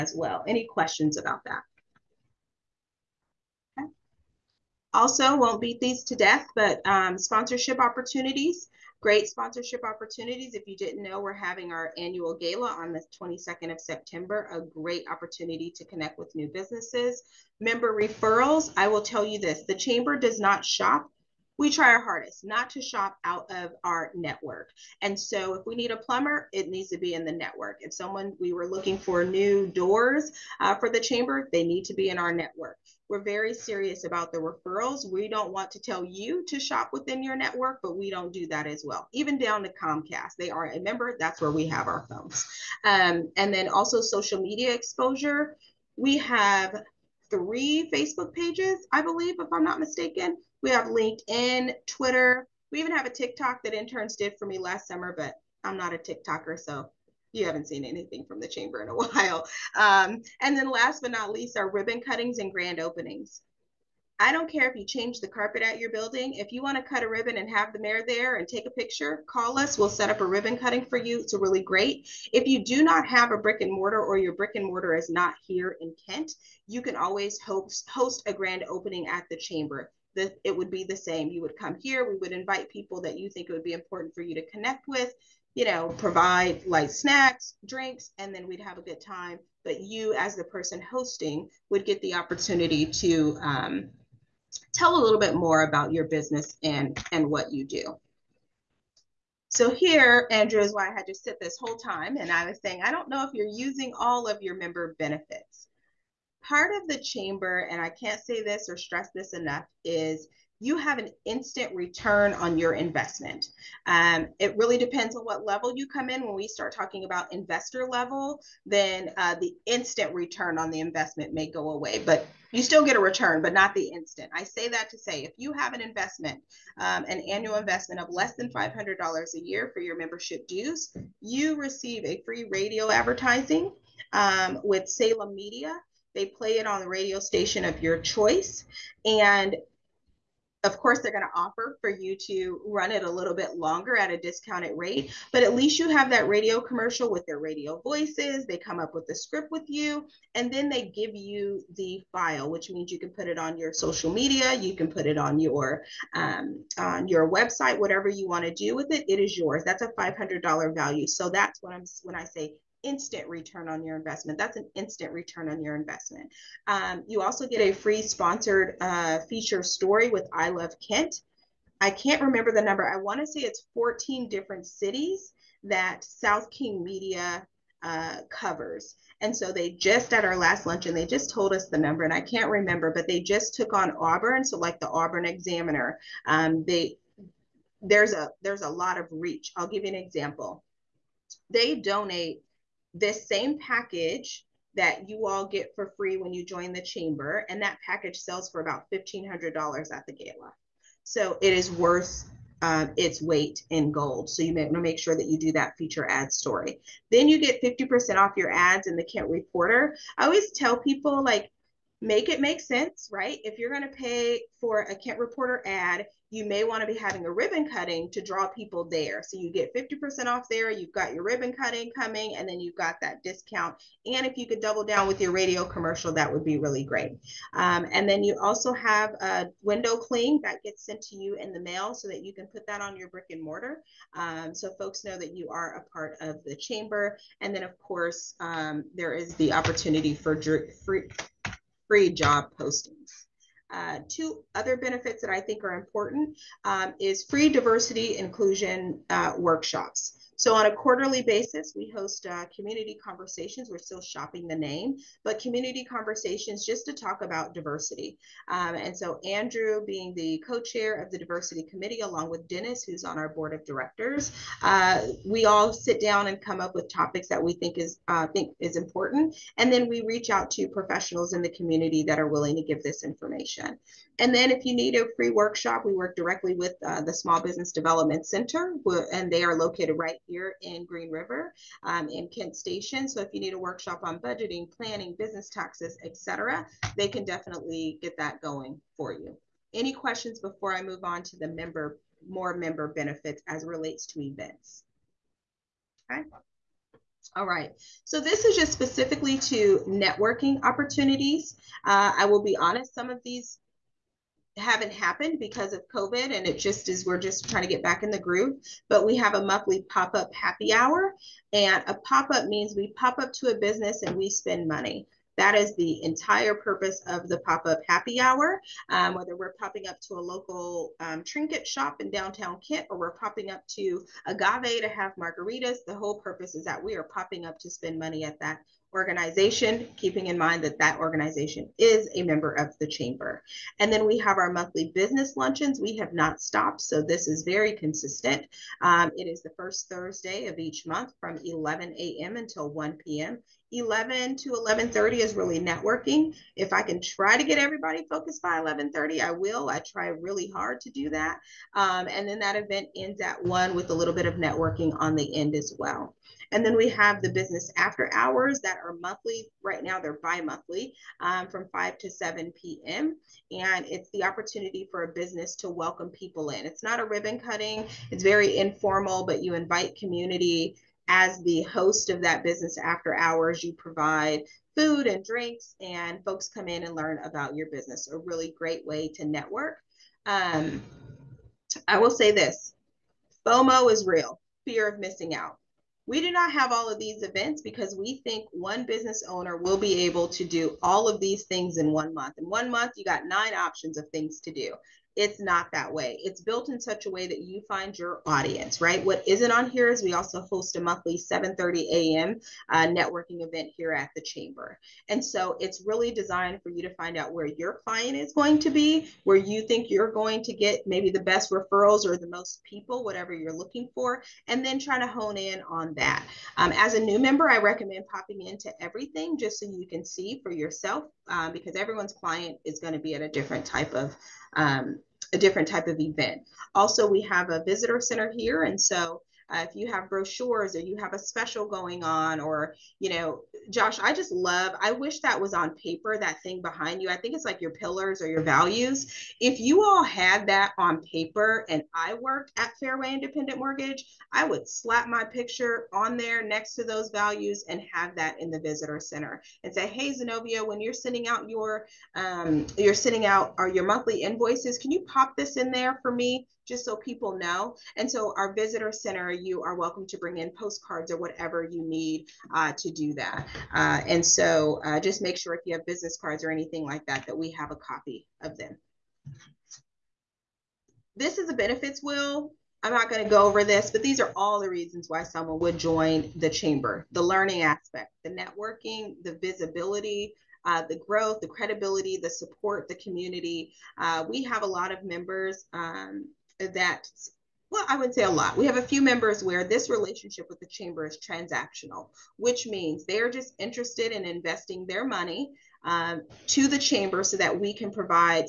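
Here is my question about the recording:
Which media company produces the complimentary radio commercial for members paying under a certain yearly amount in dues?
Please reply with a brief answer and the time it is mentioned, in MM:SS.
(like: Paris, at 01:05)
Salem Media, at 02:14.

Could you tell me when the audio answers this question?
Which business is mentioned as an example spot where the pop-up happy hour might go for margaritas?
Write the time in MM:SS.
05:24.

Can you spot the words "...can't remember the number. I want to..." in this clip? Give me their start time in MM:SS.
02:51.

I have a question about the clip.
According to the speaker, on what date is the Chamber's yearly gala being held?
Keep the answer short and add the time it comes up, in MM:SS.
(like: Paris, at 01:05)
September 22, at 00:13.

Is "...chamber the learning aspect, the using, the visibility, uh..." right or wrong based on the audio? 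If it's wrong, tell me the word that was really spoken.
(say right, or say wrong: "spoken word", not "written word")
wrong: "networking", not "using".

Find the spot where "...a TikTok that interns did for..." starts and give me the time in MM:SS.
00:53.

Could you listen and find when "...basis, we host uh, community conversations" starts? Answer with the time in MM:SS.
04:11.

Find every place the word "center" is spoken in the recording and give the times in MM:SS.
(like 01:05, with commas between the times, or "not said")
04:38, 07:07, 07:28, 07:38.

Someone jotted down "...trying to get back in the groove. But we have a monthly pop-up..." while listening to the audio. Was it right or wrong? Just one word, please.
right.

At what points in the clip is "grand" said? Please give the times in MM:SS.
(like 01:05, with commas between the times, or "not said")
01:02, 01:18.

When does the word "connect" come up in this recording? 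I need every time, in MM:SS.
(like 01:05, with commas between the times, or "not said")
00:15, 01:24.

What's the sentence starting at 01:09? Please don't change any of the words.
We'll set up a ribbon cutting for you.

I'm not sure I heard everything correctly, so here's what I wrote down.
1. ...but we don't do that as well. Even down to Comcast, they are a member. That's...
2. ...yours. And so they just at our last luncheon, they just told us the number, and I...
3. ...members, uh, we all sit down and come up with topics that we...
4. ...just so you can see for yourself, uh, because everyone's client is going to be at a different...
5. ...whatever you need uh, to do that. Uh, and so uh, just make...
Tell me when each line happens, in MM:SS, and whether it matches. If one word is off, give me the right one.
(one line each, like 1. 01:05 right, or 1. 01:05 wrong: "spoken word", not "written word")
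1. 00:37 right
2. 02:58 wrong: "covers", not "yours"
3. 04:23 wrong: "directors", not "members"
4. 06:59 right
5. 07:41 right.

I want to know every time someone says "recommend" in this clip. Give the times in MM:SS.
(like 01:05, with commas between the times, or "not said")
06:57.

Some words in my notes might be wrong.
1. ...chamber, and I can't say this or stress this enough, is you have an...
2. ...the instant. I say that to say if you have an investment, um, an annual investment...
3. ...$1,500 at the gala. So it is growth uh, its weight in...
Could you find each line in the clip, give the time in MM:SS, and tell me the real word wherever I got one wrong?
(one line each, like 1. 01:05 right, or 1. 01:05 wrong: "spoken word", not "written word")
1. 01:47 right
2. 02:03 right
3. 03:18 wrong: "worth", not "growth".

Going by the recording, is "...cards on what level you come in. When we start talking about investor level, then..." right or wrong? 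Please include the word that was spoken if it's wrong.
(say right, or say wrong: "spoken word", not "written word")
wrong: "depends", not "cards".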